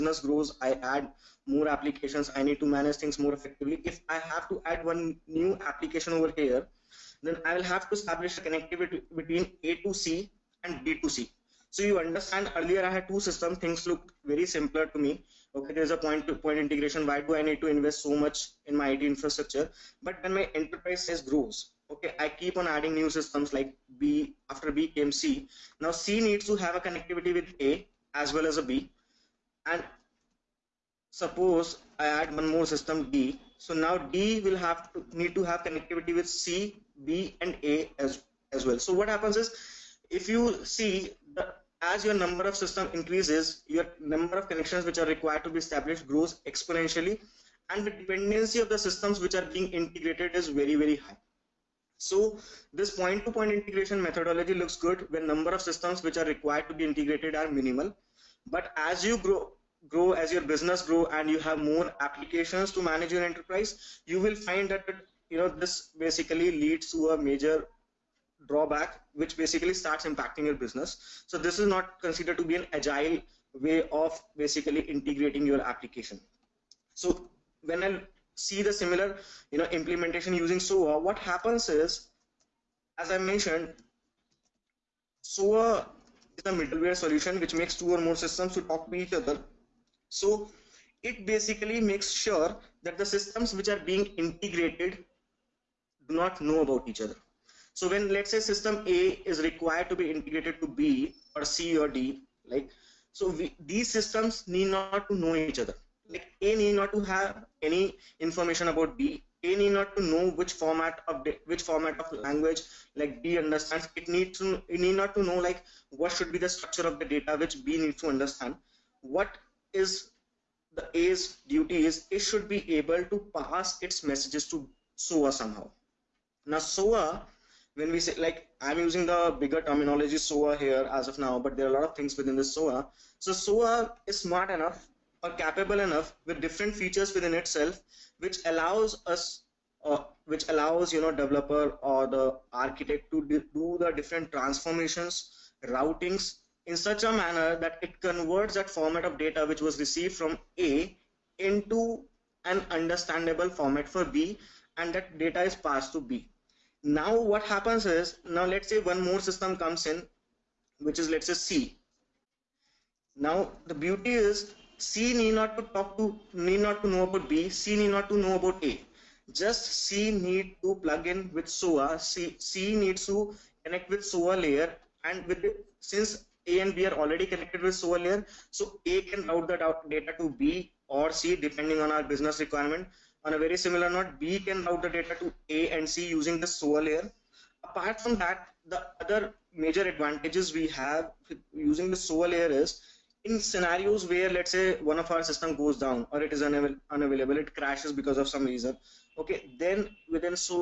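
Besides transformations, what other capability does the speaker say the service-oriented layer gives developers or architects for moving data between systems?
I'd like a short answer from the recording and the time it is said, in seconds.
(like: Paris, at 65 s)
routings, at 145 s.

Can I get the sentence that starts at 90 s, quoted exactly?
So it basically makes sure that the systems which are being integrated do not know about each other.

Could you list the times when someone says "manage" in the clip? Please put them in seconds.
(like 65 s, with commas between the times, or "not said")
2 s, 62 s.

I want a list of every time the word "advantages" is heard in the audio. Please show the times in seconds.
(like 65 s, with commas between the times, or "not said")
189 s.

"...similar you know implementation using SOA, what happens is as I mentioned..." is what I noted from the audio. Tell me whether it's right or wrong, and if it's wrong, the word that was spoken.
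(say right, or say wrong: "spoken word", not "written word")
right.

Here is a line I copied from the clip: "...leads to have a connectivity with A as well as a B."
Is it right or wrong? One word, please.
wrong.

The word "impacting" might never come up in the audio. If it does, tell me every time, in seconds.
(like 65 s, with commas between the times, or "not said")
70 s.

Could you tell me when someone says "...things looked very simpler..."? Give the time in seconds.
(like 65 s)
13 s.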